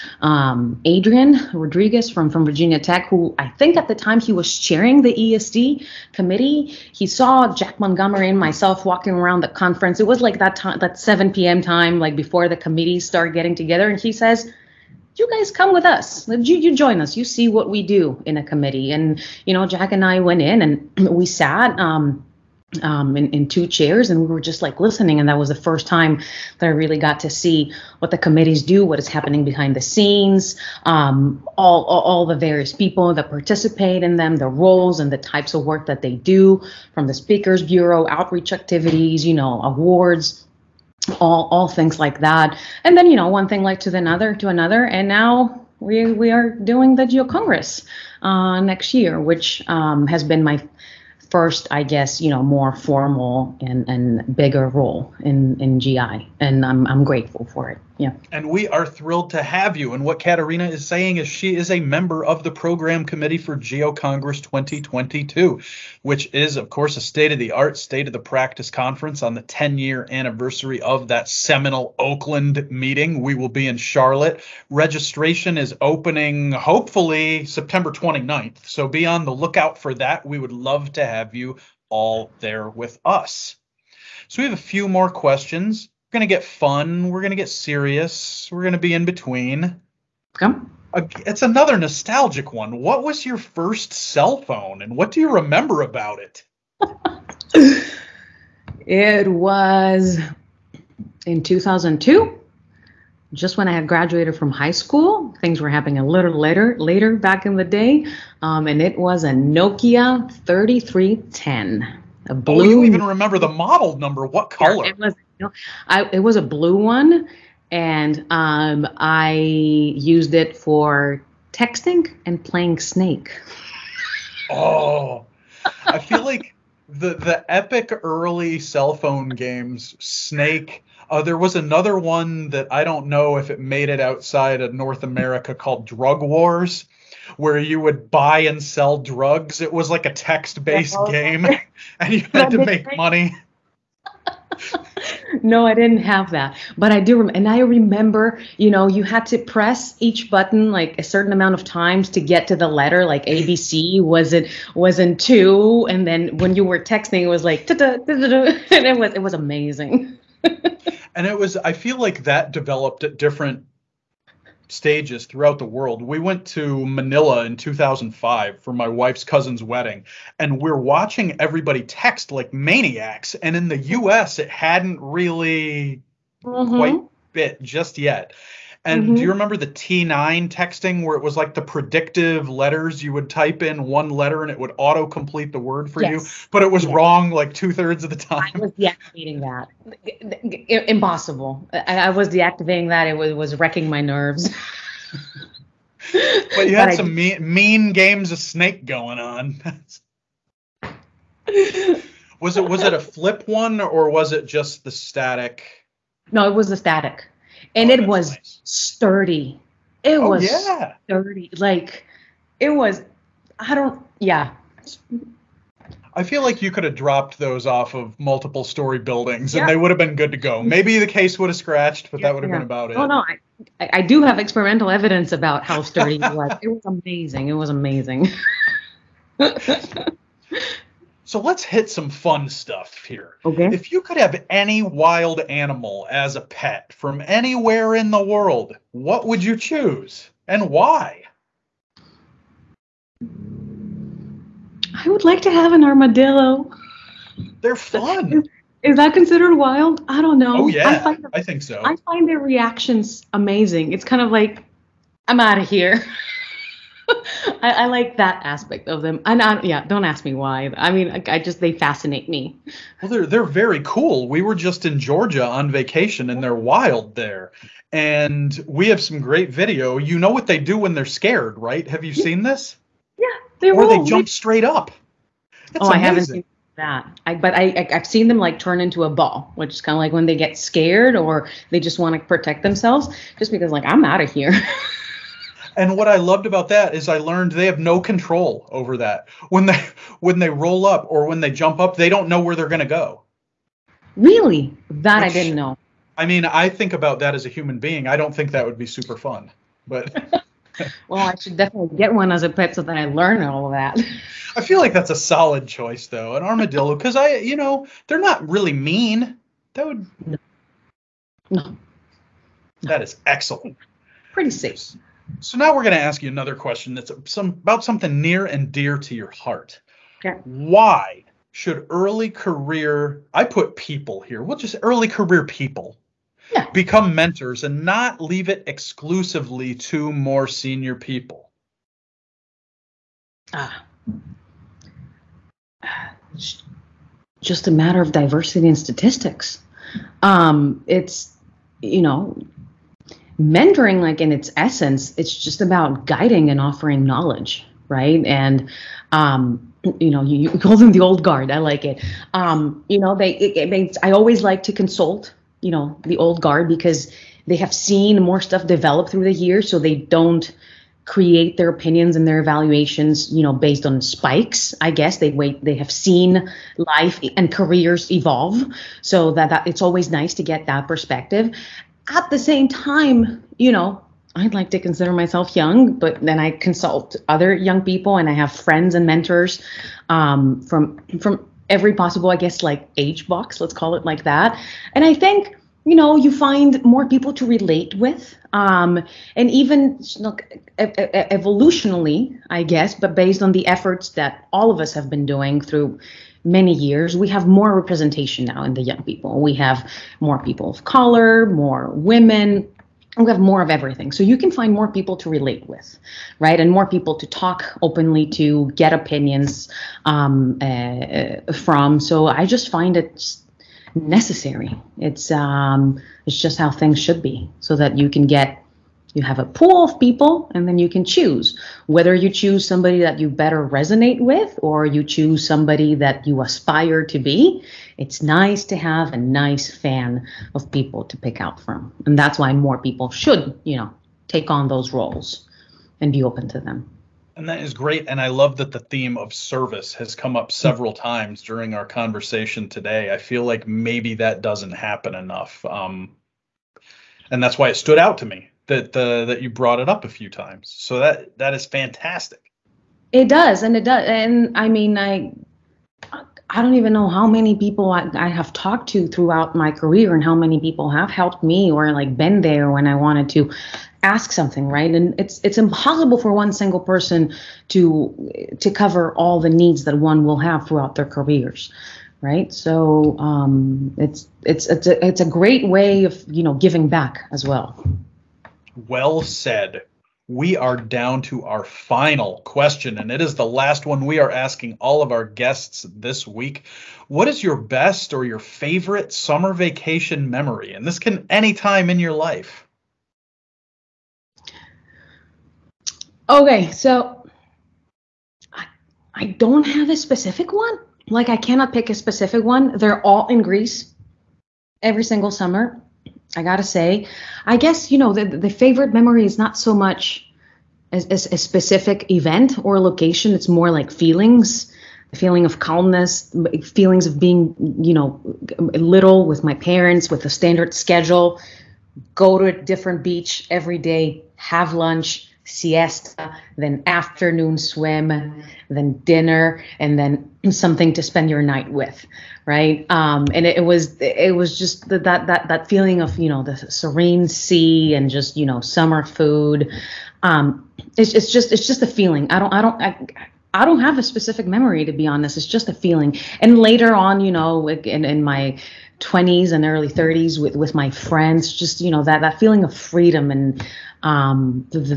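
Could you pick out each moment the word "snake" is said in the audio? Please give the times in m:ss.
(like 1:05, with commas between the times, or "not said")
2:02, 2:09, 3:18.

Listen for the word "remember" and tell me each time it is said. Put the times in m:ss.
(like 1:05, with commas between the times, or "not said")
1:35, 1:53, 2:27, 2:59.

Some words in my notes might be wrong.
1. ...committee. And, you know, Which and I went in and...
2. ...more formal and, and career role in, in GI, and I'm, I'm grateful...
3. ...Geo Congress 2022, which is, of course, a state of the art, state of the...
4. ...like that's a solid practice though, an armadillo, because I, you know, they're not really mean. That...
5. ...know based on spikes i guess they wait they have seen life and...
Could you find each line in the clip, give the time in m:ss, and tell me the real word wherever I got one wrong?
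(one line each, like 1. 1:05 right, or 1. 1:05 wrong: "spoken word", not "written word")
1. 0:18 wrong: "Jack", not "Which"
2. 0:52 wrong: "bigger", not "career"
3. 1:03 right
4. 5:04 wrong: "choice", not "practice"
5. 6:03 right.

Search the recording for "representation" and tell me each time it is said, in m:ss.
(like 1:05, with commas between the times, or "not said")
6:37.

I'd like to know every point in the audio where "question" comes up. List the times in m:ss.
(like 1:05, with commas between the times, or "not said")
1:25, 5:16, 8:02.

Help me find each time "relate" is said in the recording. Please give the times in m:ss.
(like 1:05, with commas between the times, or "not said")
6:27, 6:45.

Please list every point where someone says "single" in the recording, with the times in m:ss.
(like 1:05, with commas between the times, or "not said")
7:46, 8:25.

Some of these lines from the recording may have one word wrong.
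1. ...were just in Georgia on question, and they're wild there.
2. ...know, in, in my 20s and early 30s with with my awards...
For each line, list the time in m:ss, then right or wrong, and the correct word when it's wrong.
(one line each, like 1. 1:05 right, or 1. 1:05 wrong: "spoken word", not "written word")
1. 4:24 wrong: "vacation", not "question"
2. 9:07 wrong: "friends", not "awards".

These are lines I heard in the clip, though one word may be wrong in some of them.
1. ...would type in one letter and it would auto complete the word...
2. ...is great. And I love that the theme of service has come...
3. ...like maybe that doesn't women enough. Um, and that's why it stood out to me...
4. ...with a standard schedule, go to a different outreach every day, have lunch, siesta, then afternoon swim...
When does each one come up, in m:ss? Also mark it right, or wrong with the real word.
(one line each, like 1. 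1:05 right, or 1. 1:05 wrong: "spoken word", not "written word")
1. 3:03 right
2. 7:17 right
3. 7:23 wrong: "happen", not "women"
4. 8:40 wrong: "beach", not "outreach".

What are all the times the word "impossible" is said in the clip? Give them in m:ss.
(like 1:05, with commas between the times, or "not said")
3:10, 7:45.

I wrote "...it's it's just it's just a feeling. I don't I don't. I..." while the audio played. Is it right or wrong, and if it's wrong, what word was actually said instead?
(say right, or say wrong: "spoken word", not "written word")
right.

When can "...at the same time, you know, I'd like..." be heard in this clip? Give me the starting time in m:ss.
6:12.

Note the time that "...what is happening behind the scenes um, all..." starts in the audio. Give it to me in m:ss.
0:28.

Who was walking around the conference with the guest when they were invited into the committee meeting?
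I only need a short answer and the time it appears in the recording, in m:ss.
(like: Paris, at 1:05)
Jack Montgomery, at 0:07.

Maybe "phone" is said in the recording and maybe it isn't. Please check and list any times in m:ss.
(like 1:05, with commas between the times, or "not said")
1:34, 2:08.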